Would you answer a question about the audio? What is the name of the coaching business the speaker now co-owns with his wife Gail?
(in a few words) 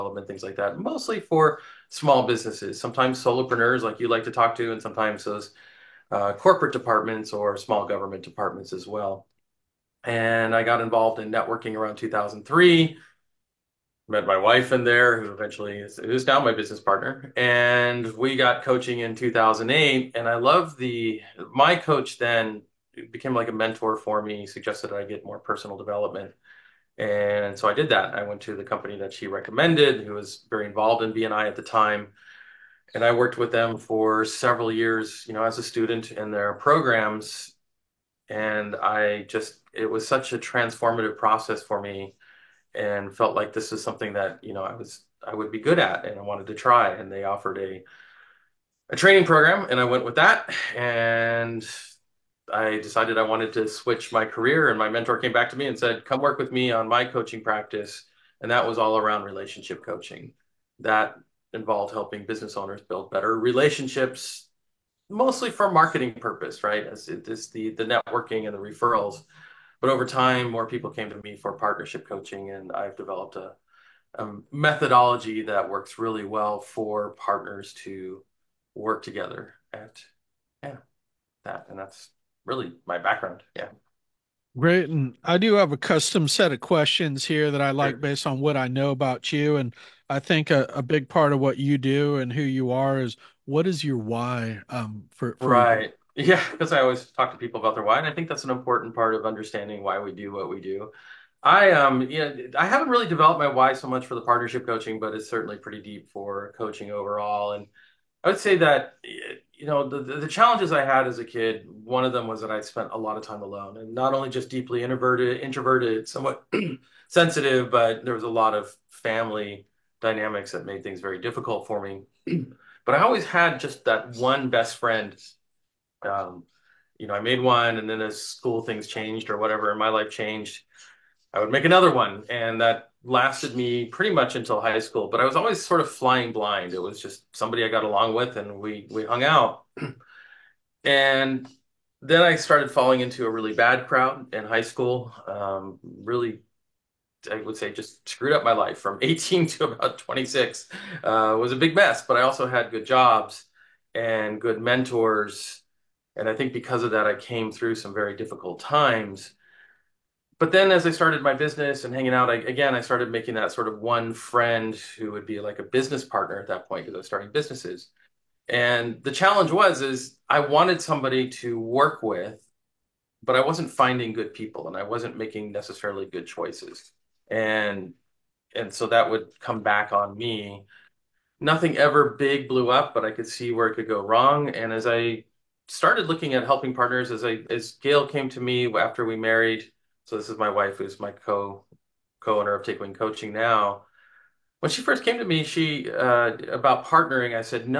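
Take Wing Coaching.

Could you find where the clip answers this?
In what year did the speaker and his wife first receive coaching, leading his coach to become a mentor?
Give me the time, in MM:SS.
00:19.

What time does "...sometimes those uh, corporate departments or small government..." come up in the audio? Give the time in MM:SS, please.
00:04.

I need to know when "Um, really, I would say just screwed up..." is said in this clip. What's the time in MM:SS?
02:25.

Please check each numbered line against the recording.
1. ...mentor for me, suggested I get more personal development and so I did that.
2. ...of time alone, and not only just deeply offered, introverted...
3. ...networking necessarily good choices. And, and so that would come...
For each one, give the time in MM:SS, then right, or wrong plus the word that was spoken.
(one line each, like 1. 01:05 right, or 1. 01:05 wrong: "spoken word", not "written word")
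1. 00:23 right
2. 01:53 wrong: "introverted", not "offered"
3. 02:55 wrong: "making", not "networking".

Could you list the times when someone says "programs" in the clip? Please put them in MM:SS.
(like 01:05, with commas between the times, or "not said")
00:36, 00:49.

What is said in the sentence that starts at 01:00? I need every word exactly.
That involved helping business owners build better relationships, mostly for marketing purpose, right?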